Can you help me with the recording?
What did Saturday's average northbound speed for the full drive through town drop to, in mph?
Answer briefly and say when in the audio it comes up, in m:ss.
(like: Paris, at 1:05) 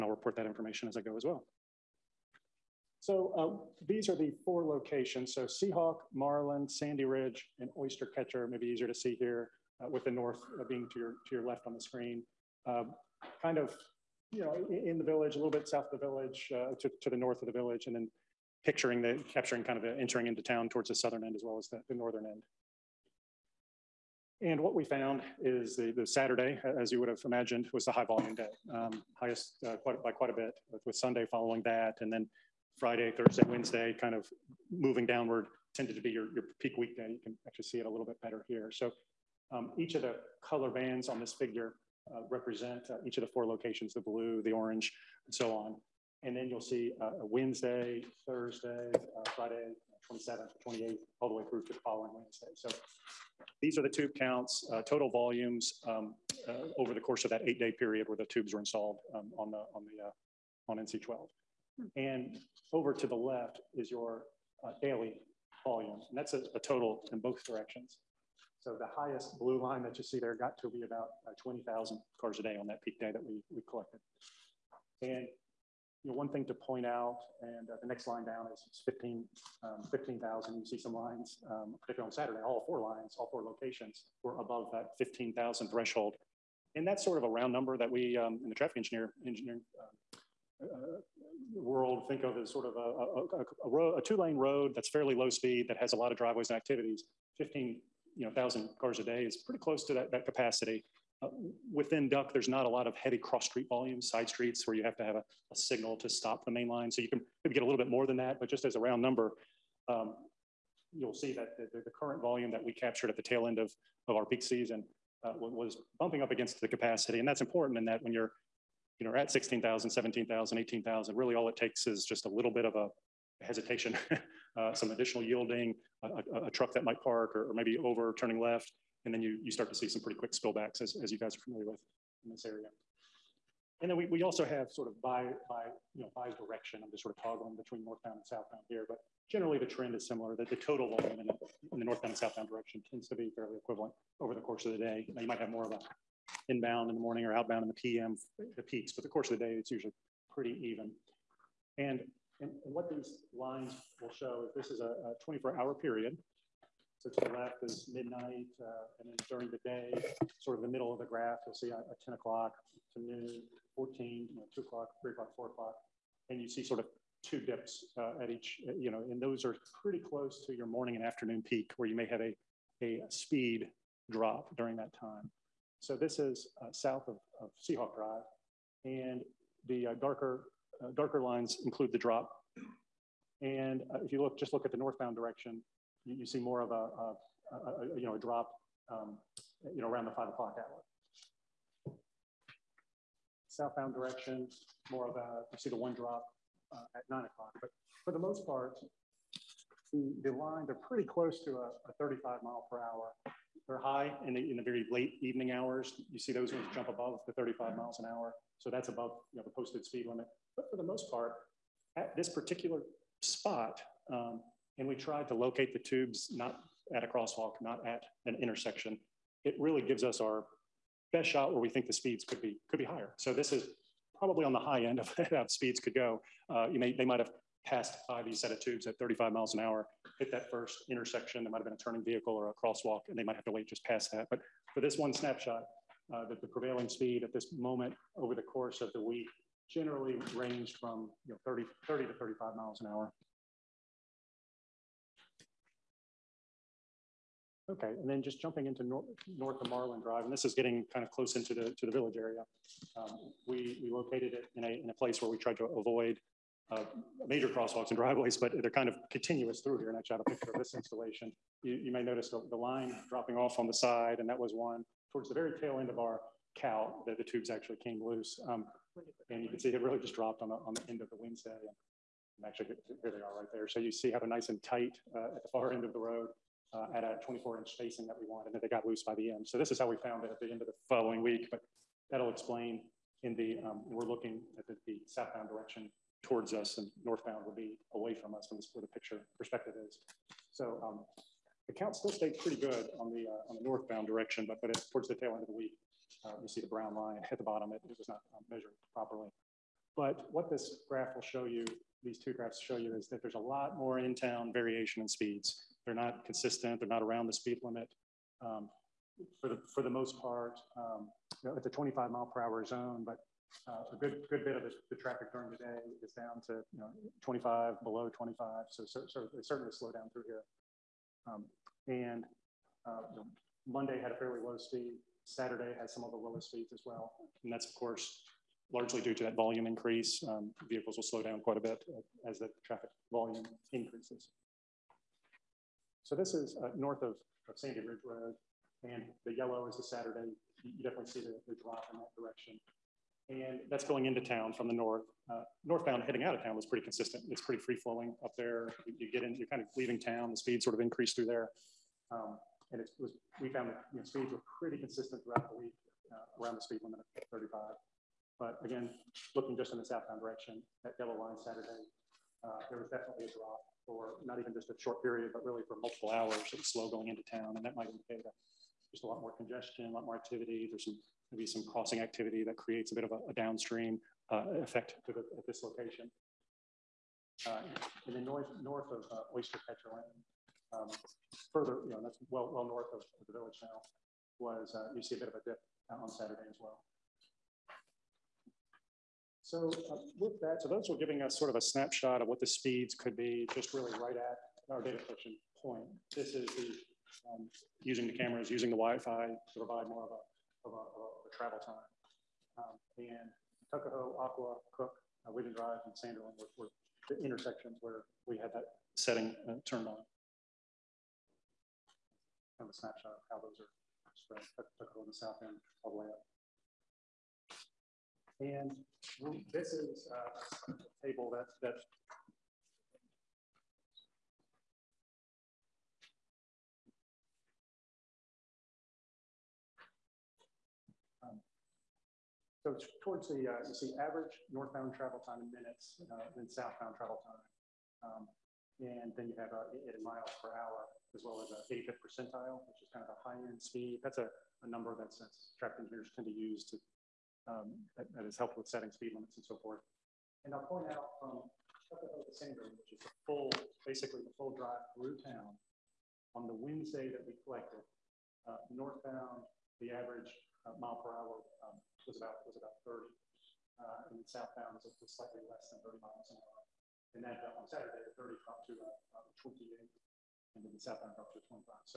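28, at 7:49.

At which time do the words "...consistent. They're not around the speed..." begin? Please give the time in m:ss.
5:06.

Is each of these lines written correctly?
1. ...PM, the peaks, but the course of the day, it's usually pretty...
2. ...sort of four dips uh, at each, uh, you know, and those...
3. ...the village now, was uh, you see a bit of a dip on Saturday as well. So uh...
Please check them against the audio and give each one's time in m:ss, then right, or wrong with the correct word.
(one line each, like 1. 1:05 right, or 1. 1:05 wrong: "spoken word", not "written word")
1. 2:27 right
2. 2:46 wrong: "two", not "four"
3. 6:23 right.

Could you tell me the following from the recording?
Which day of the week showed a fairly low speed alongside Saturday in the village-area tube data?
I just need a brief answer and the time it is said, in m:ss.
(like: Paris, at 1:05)
Monday, at 5:23.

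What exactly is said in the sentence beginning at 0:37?
You can actually see it a little bit better here.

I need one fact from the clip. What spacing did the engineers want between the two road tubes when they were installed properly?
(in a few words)
24 inches.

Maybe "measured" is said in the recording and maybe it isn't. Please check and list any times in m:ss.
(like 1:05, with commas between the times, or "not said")
4:58.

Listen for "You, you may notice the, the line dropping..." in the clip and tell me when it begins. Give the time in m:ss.
4:21.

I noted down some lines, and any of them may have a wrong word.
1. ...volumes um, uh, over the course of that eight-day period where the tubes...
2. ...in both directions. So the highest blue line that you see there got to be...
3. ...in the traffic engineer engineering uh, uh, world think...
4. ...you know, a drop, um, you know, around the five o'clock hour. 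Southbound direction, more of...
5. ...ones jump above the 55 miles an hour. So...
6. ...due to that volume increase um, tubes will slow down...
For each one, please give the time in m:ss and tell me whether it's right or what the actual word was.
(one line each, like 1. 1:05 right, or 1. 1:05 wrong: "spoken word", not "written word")
1. 0:55 right
2. 1:07 right
3. 1:28 right
4. 3:07 right
5. 3:26 wrong: "35", not "55"
6. 5:29 wrong: "vehicles", not "tubes".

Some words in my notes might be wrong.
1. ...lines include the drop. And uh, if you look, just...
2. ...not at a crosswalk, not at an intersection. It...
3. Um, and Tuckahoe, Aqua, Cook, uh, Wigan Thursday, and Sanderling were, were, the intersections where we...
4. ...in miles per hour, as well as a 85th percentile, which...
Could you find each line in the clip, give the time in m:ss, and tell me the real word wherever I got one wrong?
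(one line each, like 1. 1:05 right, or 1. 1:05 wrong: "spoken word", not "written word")
1. 3:01 right
2. 3:36 right
3. 6:42 wrong: "Drive", not "Thursday"
4. 7:19 right.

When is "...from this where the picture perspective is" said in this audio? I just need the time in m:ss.
4:48.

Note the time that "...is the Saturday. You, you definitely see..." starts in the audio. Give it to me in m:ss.
5:39.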